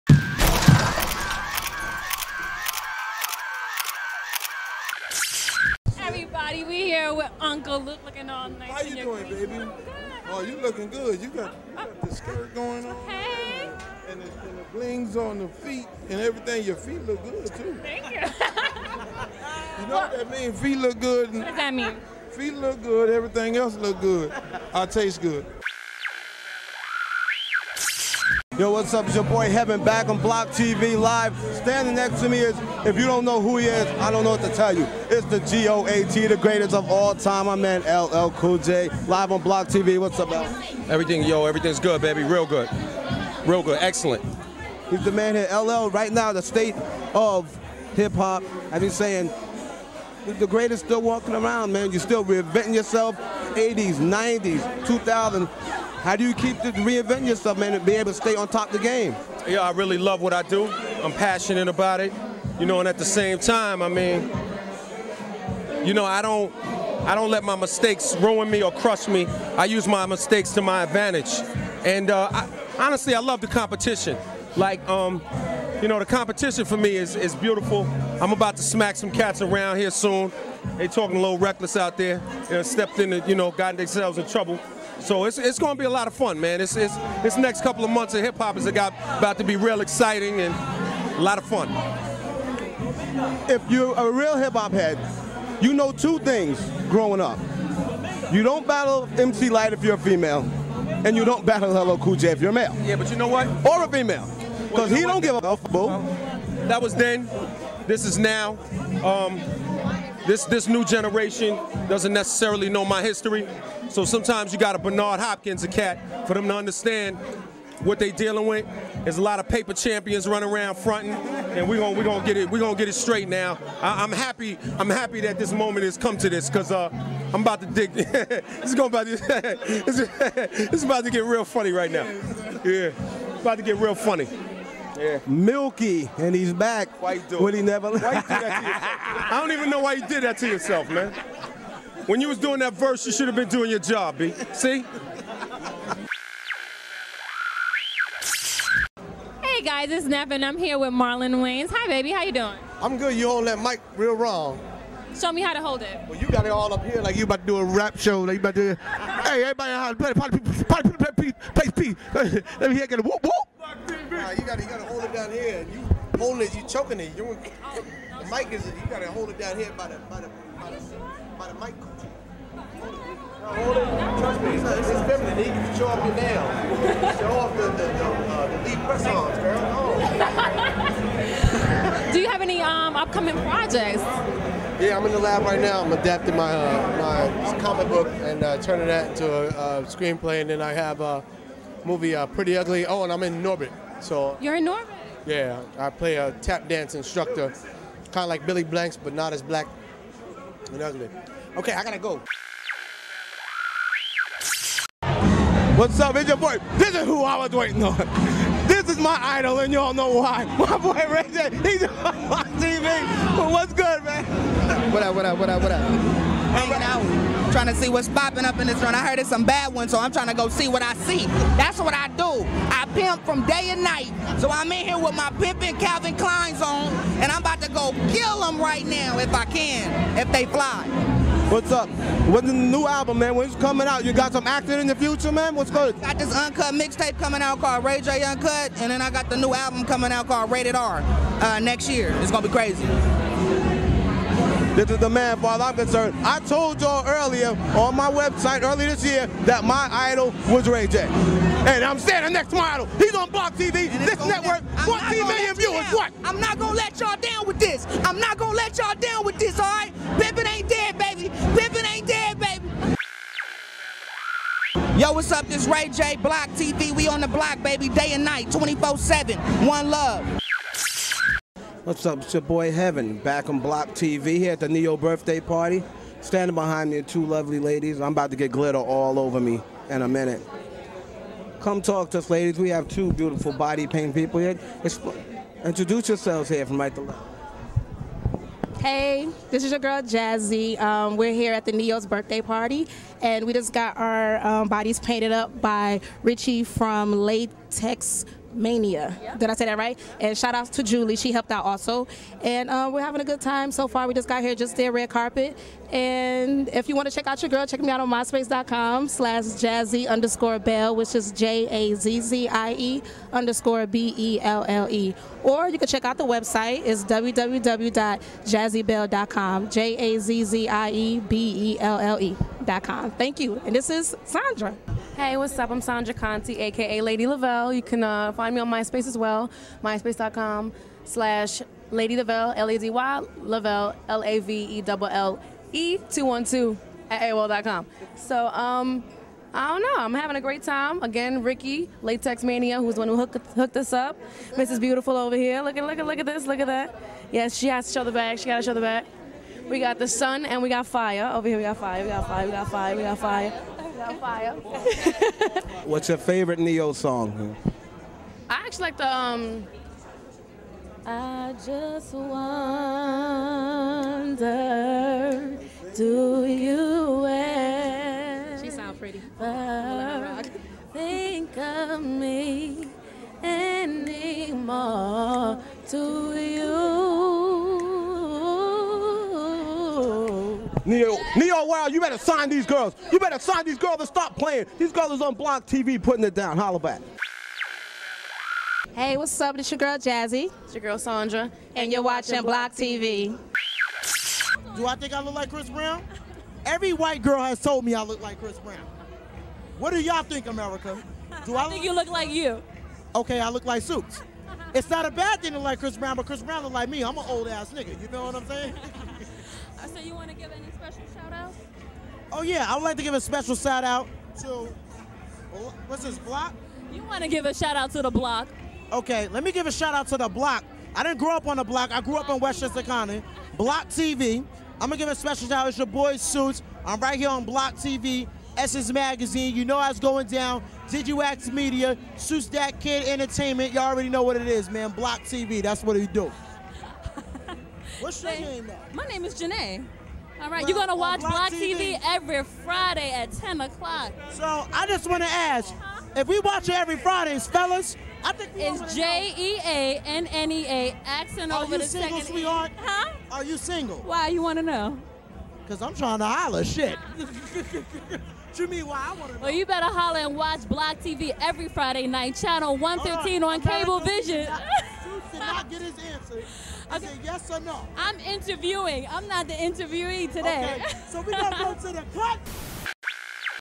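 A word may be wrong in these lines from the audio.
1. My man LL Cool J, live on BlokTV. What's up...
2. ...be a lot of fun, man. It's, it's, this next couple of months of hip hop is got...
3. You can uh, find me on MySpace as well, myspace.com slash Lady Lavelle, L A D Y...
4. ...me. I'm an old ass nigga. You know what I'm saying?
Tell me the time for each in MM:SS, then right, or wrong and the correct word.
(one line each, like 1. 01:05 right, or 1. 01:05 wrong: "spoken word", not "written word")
1. 00:37 right
2. 01:25 right
3. 05:27 right
4. 06:46 right.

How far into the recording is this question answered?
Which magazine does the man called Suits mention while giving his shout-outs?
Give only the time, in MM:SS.
07:08.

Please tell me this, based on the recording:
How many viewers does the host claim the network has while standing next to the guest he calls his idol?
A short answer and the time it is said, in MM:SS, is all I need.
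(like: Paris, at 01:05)
14 million, at 04:14.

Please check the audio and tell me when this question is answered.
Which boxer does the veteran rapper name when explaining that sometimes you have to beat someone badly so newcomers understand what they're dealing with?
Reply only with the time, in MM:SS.
01:54.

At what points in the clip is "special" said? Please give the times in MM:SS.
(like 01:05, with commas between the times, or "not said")
06:53, 07:05.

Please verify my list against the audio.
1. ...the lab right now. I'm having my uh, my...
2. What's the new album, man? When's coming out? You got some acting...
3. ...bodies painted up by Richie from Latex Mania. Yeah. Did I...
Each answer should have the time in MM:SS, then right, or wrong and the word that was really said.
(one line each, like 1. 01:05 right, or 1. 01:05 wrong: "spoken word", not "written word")
1. 03:05 wrong: "adapting", not "having"
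2. 03:52 right
3. 04:54 right.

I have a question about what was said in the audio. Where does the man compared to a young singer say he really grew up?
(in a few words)
Westchester County.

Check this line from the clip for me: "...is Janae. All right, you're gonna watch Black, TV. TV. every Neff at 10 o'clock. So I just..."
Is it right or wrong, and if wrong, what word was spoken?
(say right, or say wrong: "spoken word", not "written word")
wrong: "Friday", not "Neff".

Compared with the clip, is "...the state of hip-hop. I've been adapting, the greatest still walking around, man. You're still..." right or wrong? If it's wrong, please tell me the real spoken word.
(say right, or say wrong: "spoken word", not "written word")
wrong: "saying", not "adapting".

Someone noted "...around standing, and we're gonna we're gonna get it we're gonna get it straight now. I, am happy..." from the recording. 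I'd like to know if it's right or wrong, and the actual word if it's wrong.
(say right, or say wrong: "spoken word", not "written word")
wrong: "fronting", not "standing".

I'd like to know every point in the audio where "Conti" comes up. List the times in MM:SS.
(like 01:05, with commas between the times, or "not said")
05:26.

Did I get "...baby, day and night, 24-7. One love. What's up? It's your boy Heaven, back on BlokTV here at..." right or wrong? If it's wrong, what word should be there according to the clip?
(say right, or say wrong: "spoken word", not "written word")
right.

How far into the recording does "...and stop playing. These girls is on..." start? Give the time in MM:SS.
06:23.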